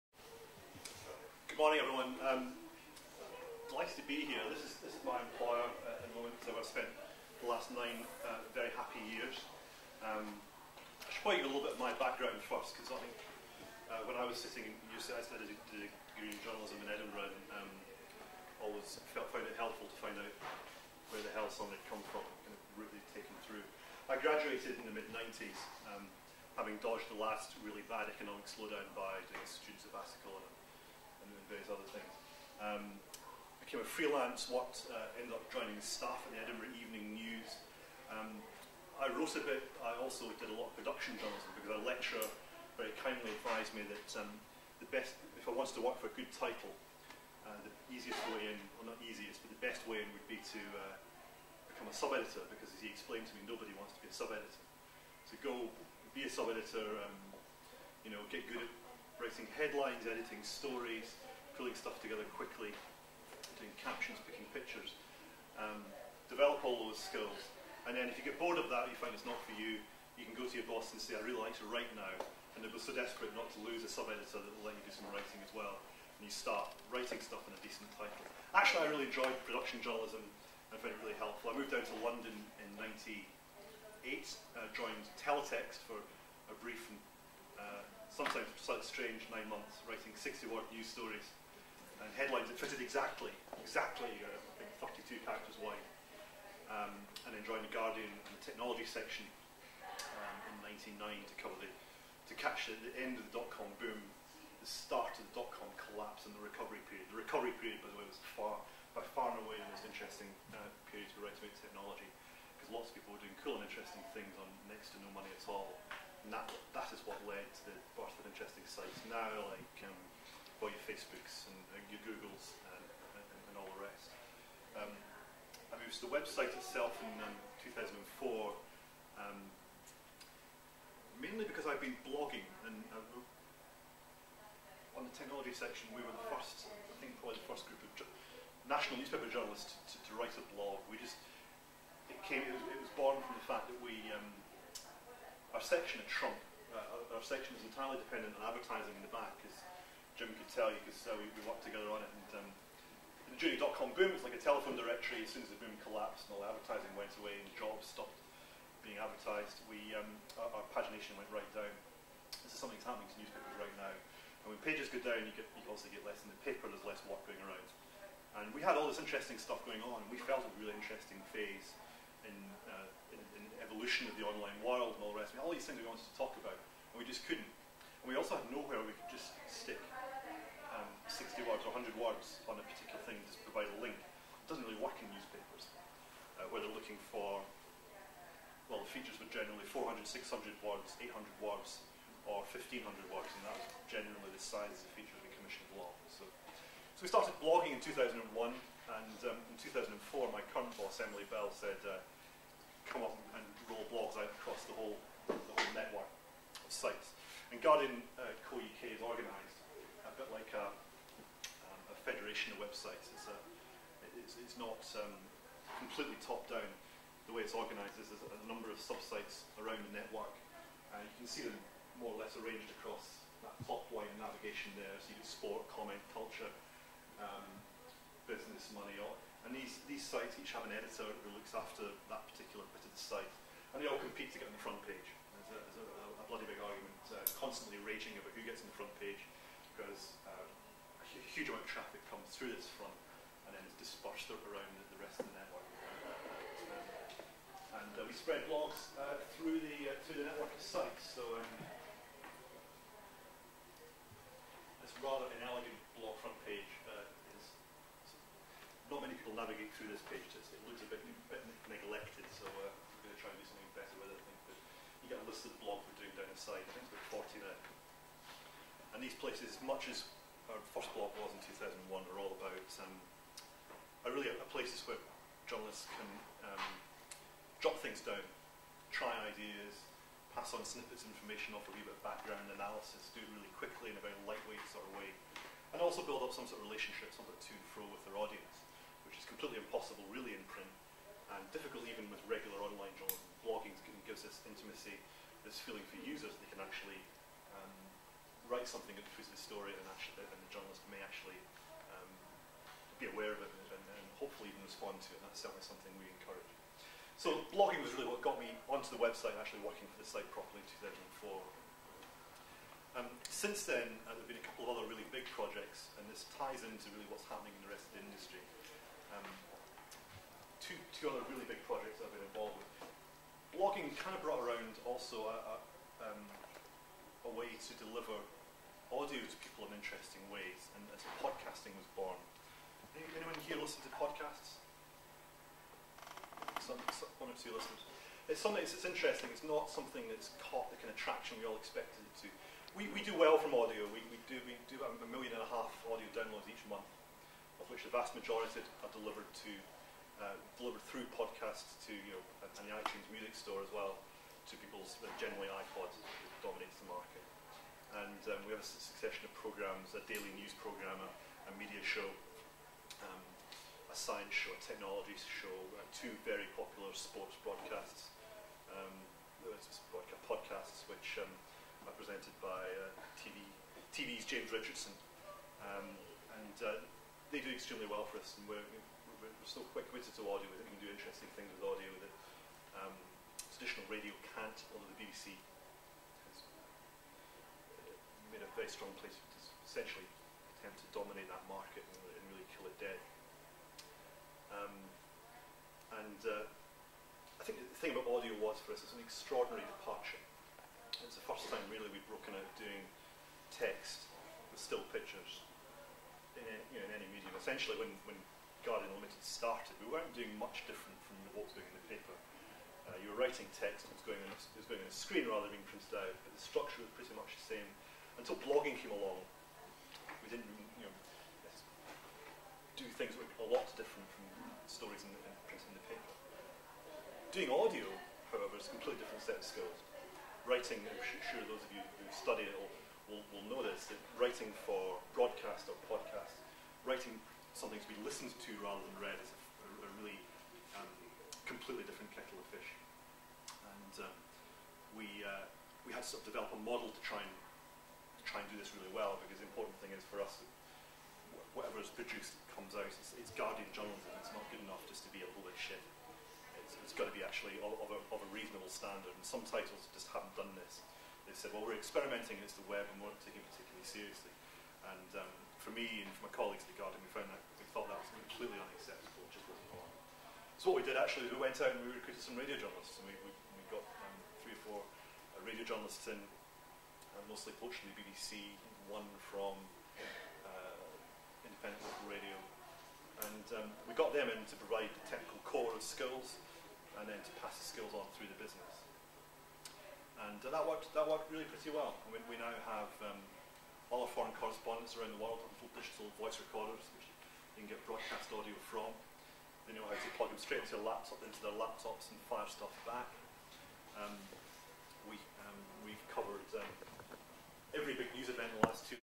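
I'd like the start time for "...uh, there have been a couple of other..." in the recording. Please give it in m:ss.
5:14.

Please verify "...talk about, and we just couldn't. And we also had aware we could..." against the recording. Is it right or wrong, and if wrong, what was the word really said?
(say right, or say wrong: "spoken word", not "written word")
wrong: "nowhere", not "aware".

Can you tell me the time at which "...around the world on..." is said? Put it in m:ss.
8:14.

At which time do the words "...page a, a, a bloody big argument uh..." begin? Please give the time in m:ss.
3:54.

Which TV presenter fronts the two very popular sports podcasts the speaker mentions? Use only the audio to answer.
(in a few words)
James Richardson.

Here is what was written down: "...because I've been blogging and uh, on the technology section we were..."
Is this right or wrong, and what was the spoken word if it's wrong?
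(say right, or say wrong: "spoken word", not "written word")
right.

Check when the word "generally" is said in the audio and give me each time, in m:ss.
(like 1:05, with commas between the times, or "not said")
3:09, 3:13, 5:55.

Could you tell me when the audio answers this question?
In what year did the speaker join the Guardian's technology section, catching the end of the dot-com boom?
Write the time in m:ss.
1:41.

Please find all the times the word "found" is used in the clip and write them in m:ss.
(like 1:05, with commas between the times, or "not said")
0:19, 1:20, 7:47.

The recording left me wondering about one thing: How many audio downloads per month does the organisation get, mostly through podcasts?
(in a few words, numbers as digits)
1.5 million.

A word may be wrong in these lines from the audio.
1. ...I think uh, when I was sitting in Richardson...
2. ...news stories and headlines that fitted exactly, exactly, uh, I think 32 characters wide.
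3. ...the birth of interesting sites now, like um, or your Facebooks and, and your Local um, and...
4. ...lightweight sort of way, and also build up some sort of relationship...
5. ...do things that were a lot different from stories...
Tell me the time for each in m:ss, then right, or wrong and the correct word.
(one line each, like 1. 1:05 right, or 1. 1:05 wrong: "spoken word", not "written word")
1. 0:12 wrong: "UCI", not "Richardson"
2. 1:30 right
3. 1:57 wrong: "Googles", not "Local"
4. 4:44 right
5. 7:02 right.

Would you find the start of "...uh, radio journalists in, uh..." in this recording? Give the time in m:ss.
7:54.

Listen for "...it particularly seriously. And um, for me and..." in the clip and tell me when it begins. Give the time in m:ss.
7:43.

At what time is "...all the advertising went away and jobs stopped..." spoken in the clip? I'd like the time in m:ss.
2:36.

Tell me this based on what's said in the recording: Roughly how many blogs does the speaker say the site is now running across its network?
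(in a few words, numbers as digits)
about 40.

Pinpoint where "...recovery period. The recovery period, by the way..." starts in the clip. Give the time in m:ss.
1:46.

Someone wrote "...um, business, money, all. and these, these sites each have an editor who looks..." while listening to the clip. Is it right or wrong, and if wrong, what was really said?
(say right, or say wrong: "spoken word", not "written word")
right.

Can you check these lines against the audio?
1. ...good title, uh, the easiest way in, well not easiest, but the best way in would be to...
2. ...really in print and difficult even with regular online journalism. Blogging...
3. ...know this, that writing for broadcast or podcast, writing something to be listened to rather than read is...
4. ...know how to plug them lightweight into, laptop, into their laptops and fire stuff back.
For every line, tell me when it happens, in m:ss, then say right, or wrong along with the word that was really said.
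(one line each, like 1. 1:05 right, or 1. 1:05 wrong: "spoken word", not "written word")
1. 0:46 right
2. 4:50 right
3. 7:13 right
4. 8:19 wrong: "straight", not "lightweight".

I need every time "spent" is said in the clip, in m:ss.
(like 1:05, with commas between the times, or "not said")
0:06.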